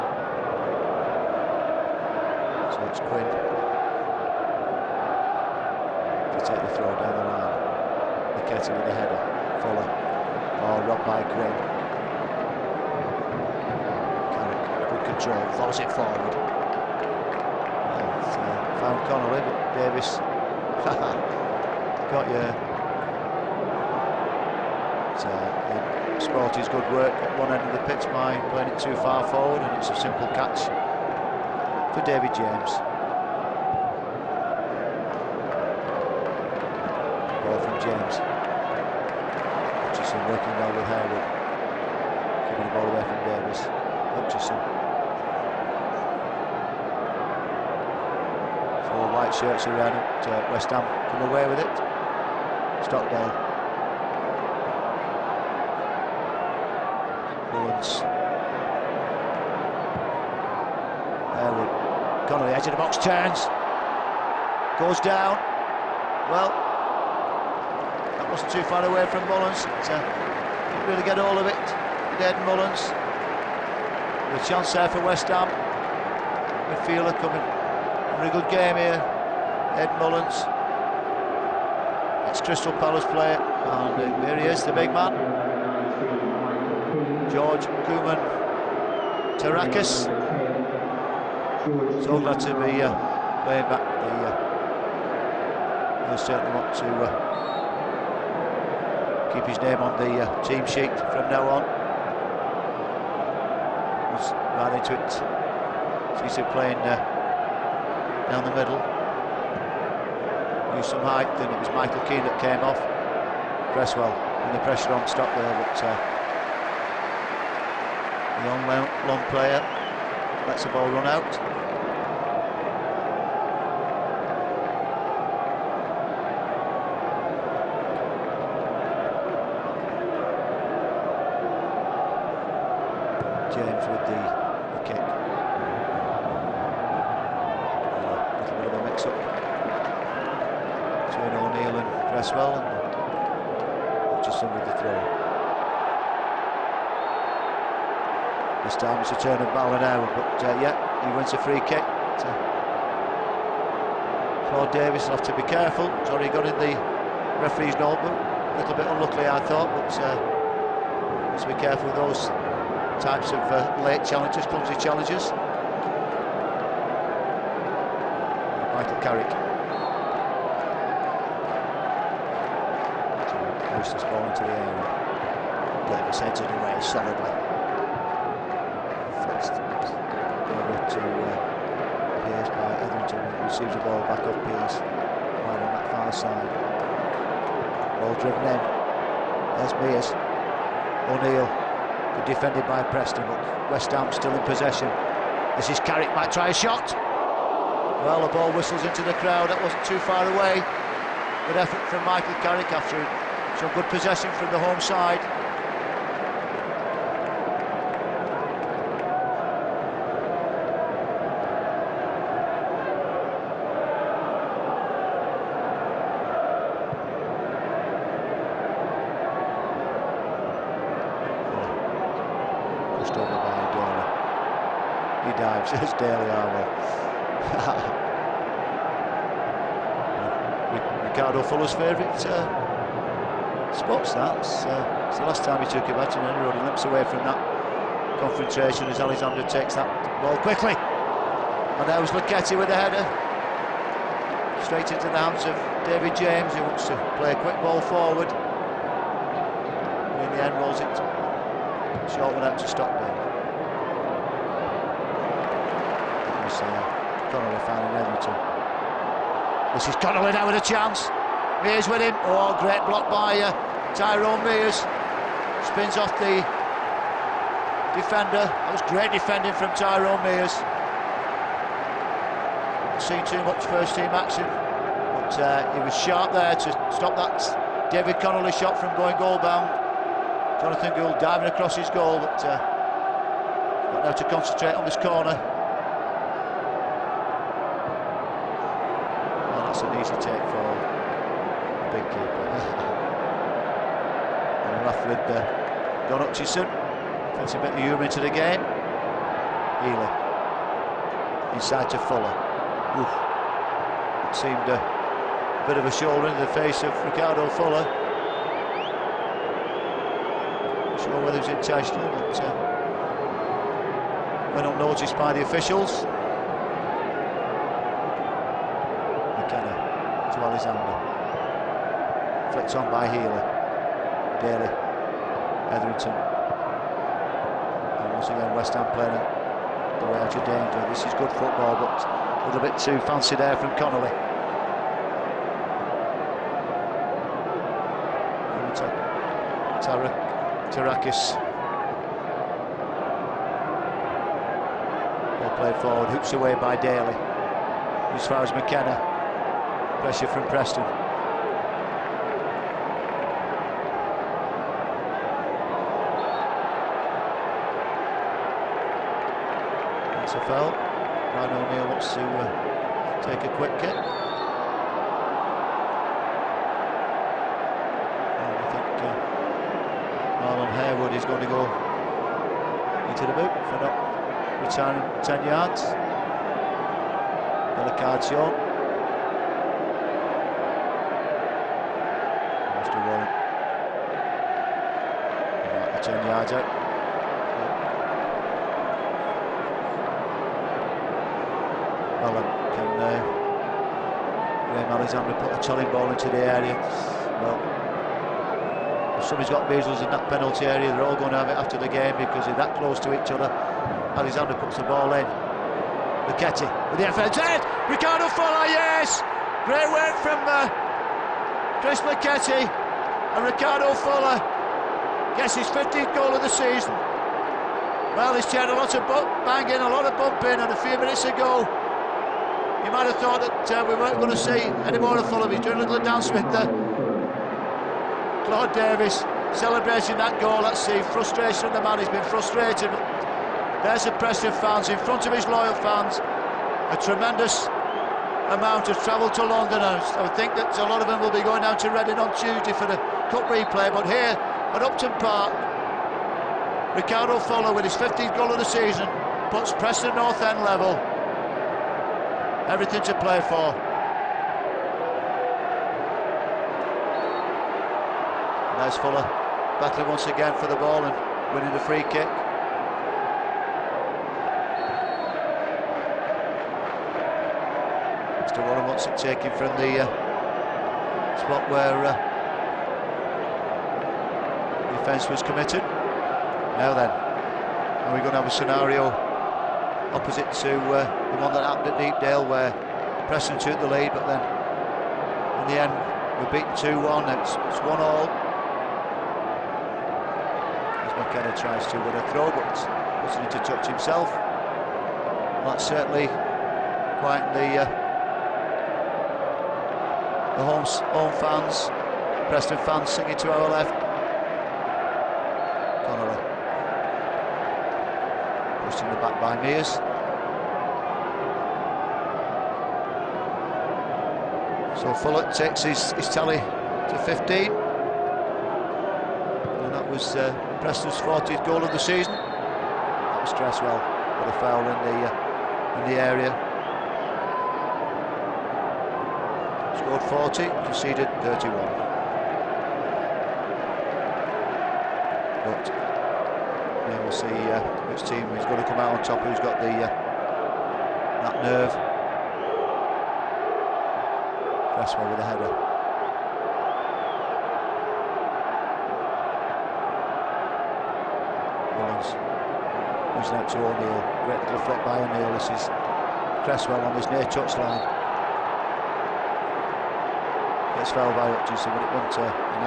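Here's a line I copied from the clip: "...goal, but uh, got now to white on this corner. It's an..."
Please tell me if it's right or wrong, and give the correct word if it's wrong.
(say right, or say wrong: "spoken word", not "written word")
wrong: "concentrate", not "white".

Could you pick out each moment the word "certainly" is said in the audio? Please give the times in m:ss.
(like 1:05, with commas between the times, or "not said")
1:36, 8:15.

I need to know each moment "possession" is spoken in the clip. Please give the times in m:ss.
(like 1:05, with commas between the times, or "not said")
3:14, 3:23.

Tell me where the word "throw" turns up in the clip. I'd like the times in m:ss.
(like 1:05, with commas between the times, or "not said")
0:06, 0:15, 8:12.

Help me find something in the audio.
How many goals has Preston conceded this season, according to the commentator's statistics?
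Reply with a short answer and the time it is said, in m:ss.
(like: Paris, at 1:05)
31, at 8:50.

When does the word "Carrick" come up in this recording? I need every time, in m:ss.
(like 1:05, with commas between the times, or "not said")
0:14, 2:49, 3:15, 3:22.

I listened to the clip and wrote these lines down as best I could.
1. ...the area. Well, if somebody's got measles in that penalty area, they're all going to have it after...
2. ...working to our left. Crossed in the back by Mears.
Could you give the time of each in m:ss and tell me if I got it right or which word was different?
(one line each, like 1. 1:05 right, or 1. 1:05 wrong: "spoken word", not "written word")
1. 6:36 right
2. 8:23 wrong: "singing", not "working".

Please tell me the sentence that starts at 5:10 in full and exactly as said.
Not sure whether it was intentional, but uh, went unnoticed by the officials.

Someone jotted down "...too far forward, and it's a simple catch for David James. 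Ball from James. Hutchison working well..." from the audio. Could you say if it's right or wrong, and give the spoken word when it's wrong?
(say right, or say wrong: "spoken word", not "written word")
right.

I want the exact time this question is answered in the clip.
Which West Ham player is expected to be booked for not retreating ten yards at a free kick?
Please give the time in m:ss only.
6:10.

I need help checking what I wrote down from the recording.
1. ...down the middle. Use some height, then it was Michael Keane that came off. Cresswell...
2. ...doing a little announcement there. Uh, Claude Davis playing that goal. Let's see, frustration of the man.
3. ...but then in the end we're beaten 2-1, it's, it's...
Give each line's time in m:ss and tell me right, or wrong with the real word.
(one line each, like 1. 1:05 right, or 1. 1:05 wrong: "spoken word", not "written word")
1. 1:48 right
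2. 7:05 wrong: "celebrating", not "playing"
3. 8:04 right.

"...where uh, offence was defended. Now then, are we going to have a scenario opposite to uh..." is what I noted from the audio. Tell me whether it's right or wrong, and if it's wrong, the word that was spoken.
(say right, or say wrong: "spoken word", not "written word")
wrong: "committed", not "defended".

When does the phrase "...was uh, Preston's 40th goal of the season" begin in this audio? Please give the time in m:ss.
8:40.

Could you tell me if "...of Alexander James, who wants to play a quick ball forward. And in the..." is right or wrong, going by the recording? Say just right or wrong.
wrong.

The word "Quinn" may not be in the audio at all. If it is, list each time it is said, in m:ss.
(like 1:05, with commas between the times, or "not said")
0:02, 0:11.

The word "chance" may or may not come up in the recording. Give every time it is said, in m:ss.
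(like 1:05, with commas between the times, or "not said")
1:14, 4:20.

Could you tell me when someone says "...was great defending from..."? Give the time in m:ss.
4:28.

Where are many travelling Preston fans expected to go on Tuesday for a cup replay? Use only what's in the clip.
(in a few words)
Reading.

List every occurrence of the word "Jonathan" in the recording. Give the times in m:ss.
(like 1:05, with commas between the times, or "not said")
4:40.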